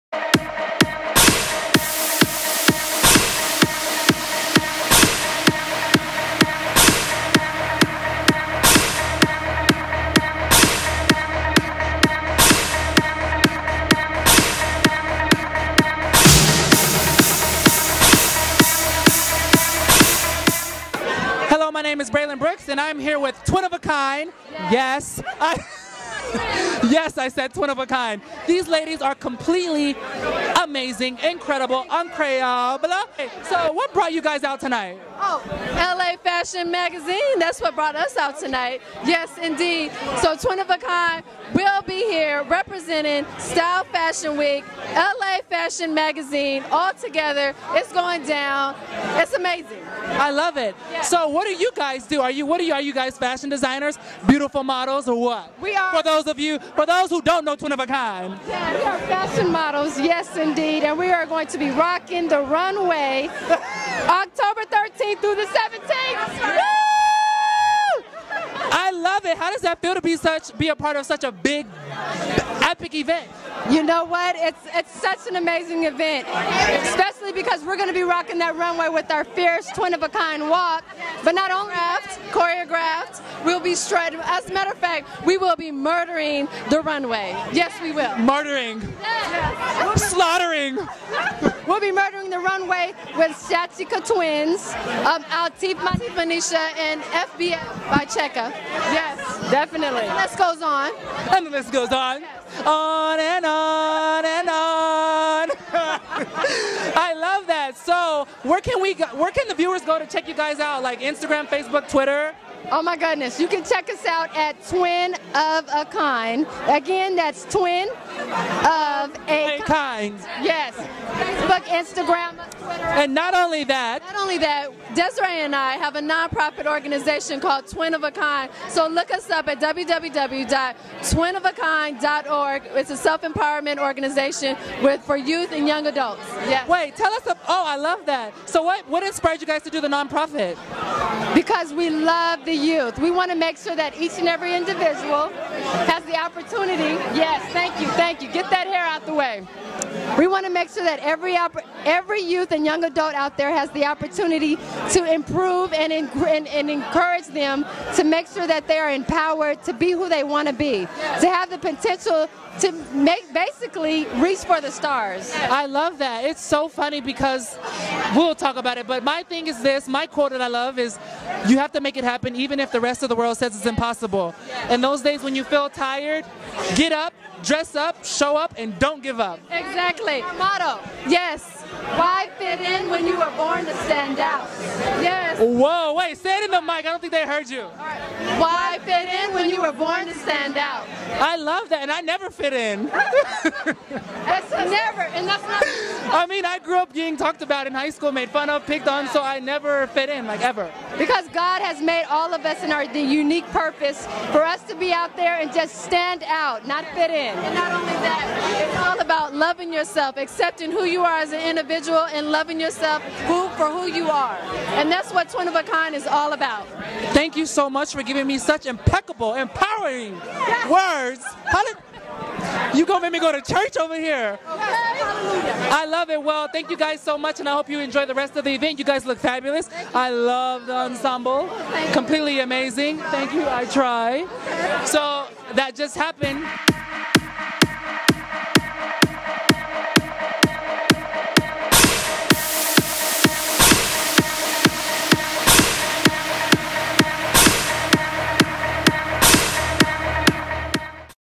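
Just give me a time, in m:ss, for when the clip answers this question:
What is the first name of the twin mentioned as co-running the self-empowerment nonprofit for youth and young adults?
2:04.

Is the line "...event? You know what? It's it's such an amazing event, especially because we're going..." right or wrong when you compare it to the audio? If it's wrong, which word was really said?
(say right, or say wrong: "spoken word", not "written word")
right.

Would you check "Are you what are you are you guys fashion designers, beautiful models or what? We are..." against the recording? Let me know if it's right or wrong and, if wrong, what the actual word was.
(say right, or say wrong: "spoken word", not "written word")
right.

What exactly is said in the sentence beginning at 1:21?
But not only choreographed, choreographed, we'll be strutting.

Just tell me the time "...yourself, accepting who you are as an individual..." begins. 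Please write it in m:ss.
3:29.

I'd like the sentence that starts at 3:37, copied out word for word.
Thank you so much for giving me such impeccable powerful, empowering yes.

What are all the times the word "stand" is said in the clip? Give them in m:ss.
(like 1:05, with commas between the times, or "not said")
3:03, 3:10, 3:25.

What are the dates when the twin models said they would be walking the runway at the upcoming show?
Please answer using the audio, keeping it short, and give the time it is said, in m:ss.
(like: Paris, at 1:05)
October 13th through the 17th, at 1:04.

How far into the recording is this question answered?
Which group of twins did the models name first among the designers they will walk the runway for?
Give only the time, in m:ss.
1:33.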